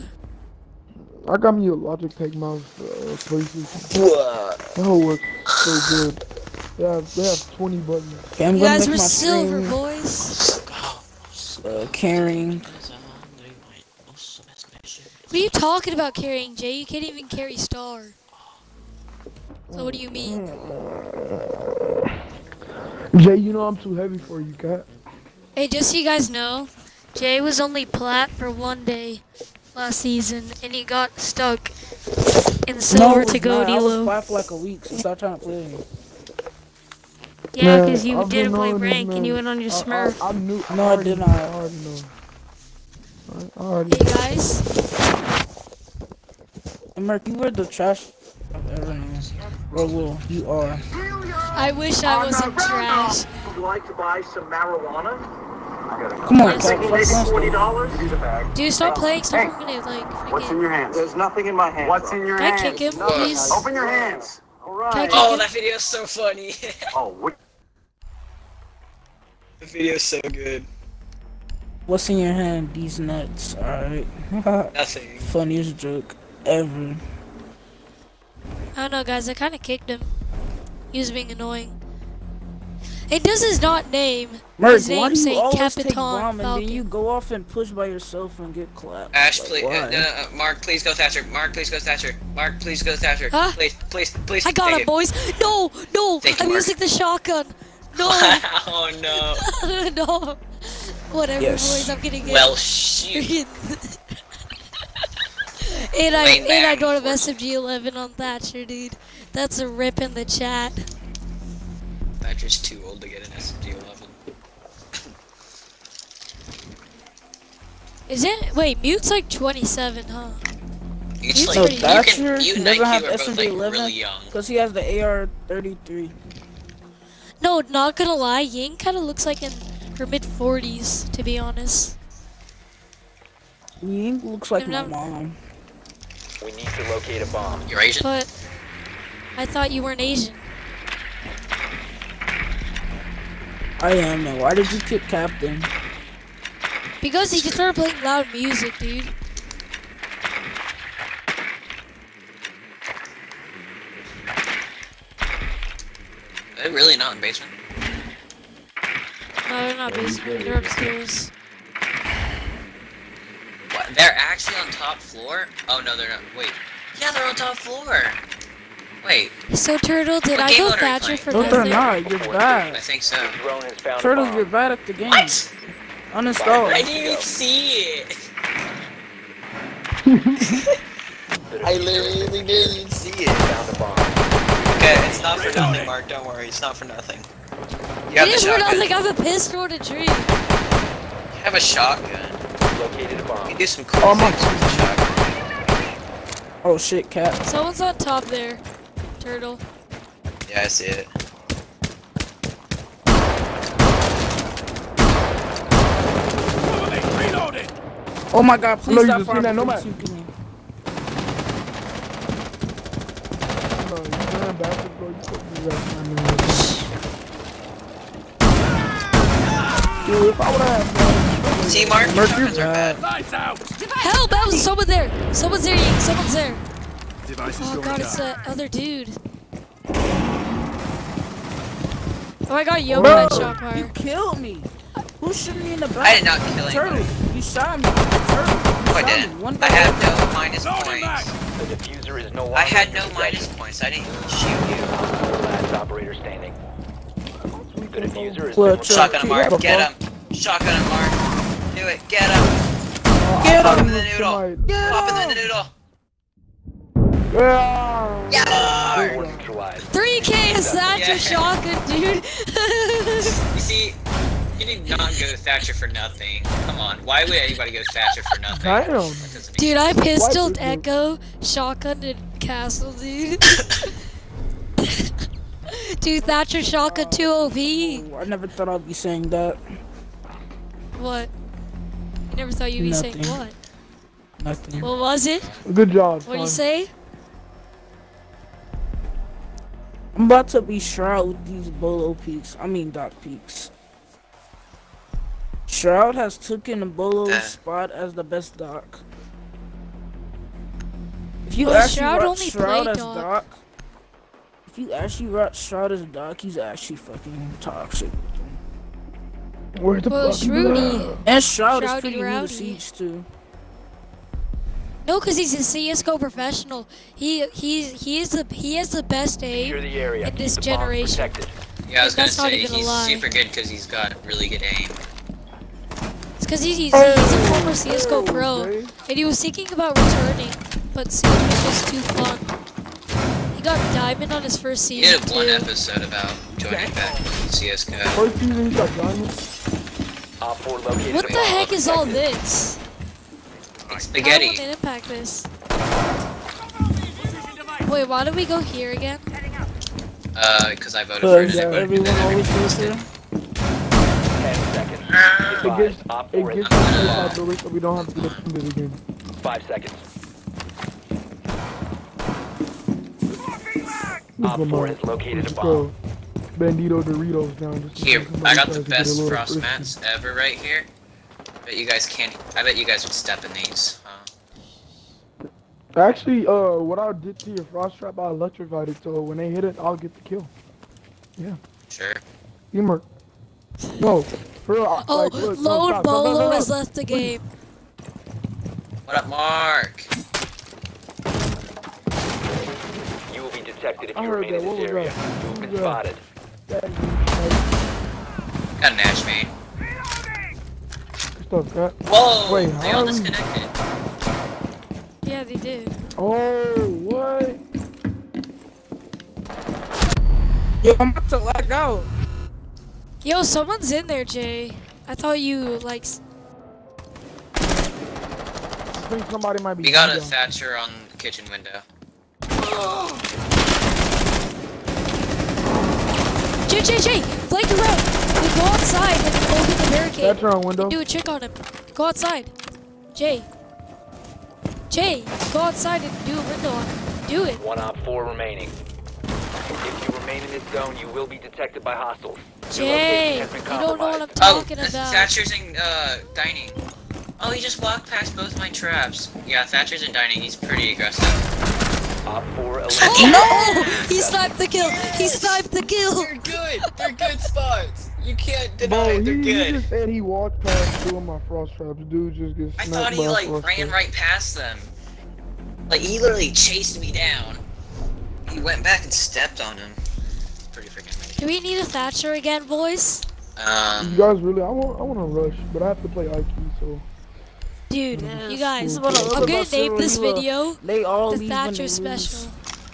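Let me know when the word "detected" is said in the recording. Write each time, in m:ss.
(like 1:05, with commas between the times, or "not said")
6:33, 7:21.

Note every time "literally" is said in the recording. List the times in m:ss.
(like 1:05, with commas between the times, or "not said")
3:01, 7:46.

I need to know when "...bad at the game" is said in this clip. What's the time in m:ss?
2:54.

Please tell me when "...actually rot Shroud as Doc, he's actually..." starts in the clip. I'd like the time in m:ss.
5:04.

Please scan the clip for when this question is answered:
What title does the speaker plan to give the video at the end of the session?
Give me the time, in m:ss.
8:00.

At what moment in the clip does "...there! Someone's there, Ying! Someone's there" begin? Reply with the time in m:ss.
3:44.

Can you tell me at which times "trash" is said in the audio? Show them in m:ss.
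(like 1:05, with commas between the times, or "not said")
0:47, 0:52.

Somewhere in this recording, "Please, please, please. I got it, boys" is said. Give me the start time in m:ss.
1:33.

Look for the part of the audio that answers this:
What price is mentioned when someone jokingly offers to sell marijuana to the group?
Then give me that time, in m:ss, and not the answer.
0:56.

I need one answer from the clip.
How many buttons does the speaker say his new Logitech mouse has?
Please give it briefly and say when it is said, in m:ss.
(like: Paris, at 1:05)
20, at 0:07.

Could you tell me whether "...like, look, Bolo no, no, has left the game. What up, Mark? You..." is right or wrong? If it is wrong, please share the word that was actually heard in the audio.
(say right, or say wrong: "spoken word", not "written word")
right.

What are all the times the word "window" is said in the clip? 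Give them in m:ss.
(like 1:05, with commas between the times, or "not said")
7:01, 7:10, 7:16.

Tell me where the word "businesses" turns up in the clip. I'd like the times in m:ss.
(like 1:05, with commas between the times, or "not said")
not said.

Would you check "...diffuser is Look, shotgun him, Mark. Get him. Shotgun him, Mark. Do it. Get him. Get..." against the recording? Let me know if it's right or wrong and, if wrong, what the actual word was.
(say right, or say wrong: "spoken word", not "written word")
right.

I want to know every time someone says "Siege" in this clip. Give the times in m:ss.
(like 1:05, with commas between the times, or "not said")
5:12, 5:31.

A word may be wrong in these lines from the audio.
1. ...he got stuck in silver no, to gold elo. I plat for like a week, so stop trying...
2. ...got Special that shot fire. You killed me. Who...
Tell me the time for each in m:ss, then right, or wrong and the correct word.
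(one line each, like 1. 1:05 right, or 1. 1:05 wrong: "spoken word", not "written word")
1. 0:30 right
2. 3:52 wrong: "Yoga", not "Special".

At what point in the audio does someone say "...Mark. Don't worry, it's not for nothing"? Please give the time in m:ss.
3:05.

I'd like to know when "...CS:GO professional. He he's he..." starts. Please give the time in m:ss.
5:15.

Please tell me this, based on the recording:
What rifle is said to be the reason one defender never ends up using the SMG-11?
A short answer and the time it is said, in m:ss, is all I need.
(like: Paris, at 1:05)
AR-33, at 2:05.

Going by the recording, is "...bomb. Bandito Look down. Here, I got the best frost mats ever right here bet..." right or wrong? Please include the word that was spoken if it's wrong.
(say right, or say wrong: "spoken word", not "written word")
wrong: "Doritos", not "Look".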